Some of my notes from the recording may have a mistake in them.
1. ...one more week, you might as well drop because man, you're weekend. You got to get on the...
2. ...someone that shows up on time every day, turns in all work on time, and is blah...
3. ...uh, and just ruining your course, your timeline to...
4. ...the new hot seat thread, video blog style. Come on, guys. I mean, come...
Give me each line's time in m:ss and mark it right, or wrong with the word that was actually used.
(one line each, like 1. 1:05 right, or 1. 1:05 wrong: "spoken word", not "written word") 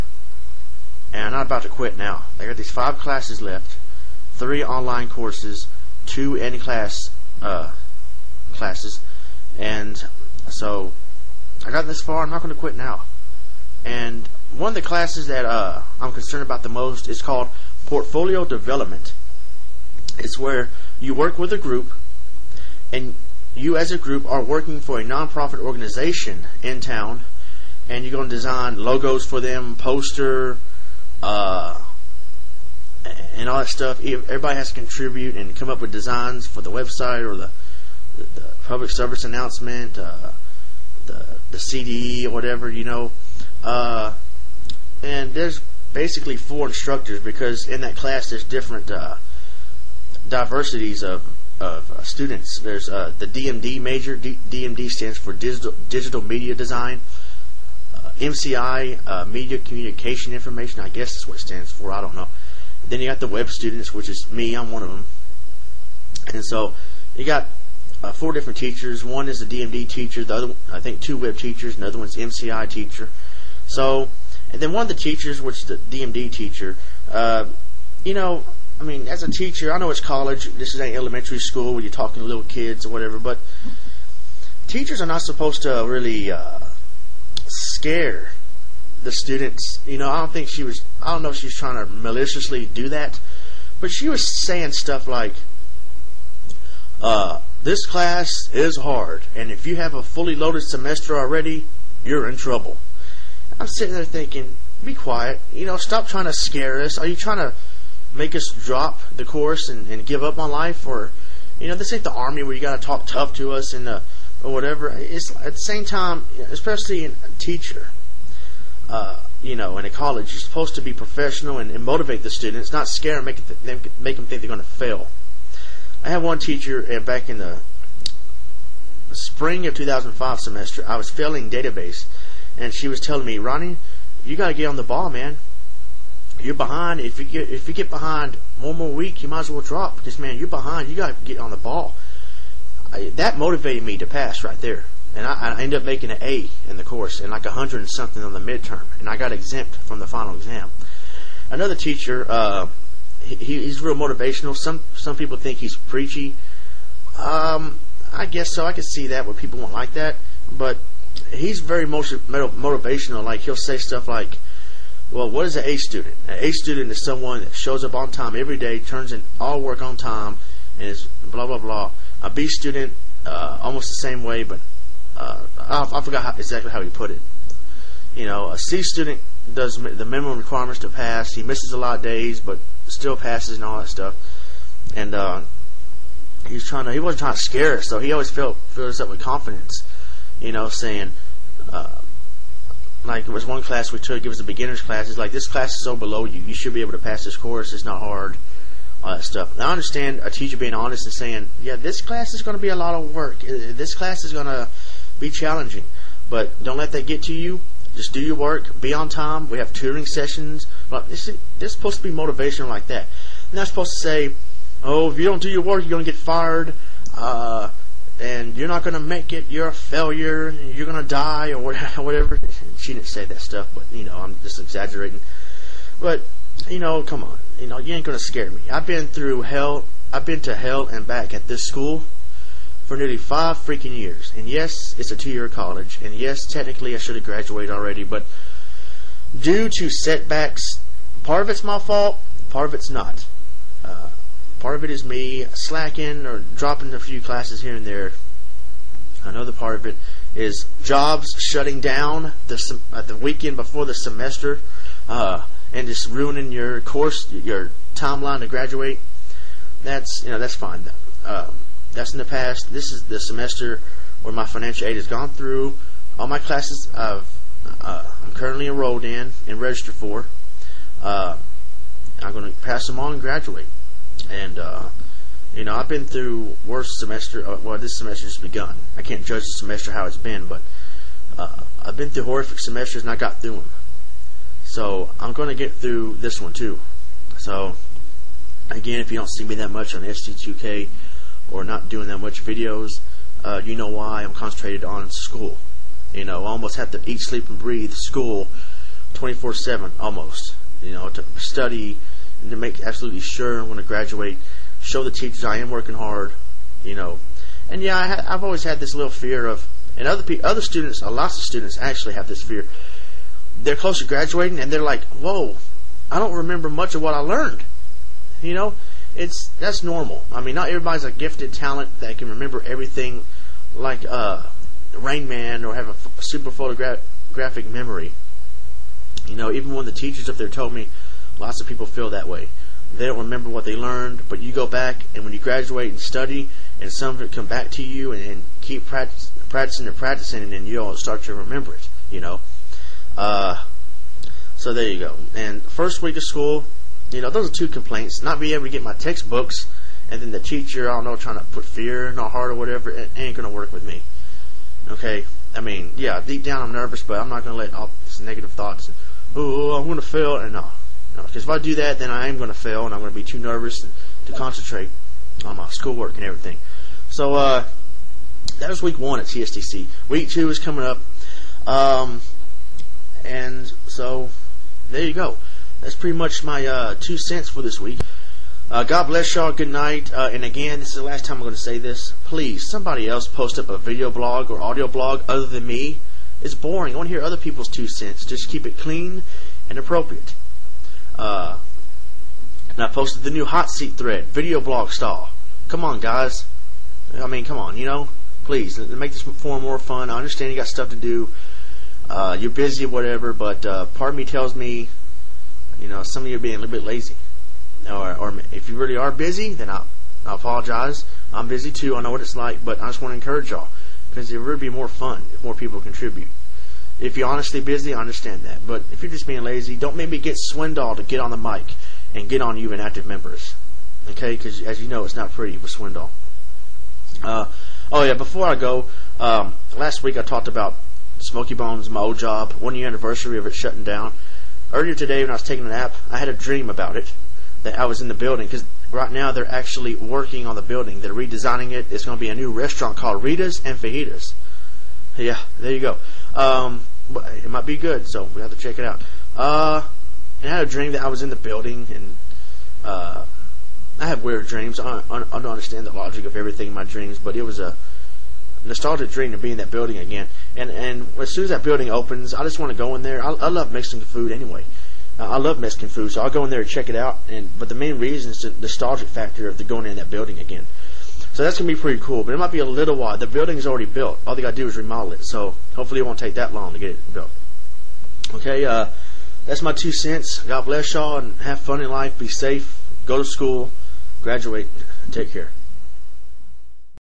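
1. 2:18 wrong: "behind", not "weekend"
2. 2:47 right
3. 4:15 right
4. 6:33 right.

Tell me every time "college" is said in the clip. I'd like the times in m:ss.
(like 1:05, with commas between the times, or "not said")
1:20, 1:59, 3:55.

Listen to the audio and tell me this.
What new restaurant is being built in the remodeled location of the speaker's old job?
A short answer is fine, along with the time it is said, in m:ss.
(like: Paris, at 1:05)
Rita's and Fajitas, at 7:23.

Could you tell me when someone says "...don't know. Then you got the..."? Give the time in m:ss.
1:02.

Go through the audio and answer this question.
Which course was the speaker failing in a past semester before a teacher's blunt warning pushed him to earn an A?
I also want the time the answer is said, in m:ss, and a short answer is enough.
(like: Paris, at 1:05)
Database, at 2:11.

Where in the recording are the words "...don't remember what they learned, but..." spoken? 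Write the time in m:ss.
5:33.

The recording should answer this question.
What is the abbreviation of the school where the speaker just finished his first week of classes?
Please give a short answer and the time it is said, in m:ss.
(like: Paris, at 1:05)
TSTC, at 6:09.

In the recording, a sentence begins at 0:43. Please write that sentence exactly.
Uh, and there's basically four instructors because in that class there's different uh, diversities of of uh, students.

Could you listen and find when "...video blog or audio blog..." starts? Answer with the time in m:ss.
6:23.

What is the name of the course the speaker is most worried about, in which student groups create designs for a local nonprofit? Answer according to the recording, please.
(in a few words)
Portfolio development.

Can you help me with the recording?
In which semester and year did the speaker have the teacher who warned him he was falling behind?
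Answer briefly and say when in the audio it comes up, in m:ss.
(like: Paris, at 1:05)
Spring 2005, at 2:09.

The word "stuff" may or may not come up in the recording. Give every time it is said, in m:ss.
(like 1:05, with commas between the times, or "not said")
0:33, 1:34, 2:43, 3:03, 3:19, 3:43, 6:40.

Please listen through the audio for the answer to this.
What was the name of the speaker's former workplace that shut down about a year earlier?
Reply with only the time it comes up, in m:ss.
7:11.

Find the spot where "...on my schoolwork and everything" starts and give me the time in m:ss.
6:05.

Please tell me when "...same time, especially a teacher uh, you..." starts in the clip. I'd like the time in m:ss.
1:55.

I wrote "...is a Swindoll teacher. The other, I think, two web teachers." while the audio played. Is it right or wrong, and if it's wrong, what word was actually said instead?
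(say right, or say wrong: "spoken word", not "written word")
wrong: "DMD", not "Swindoll".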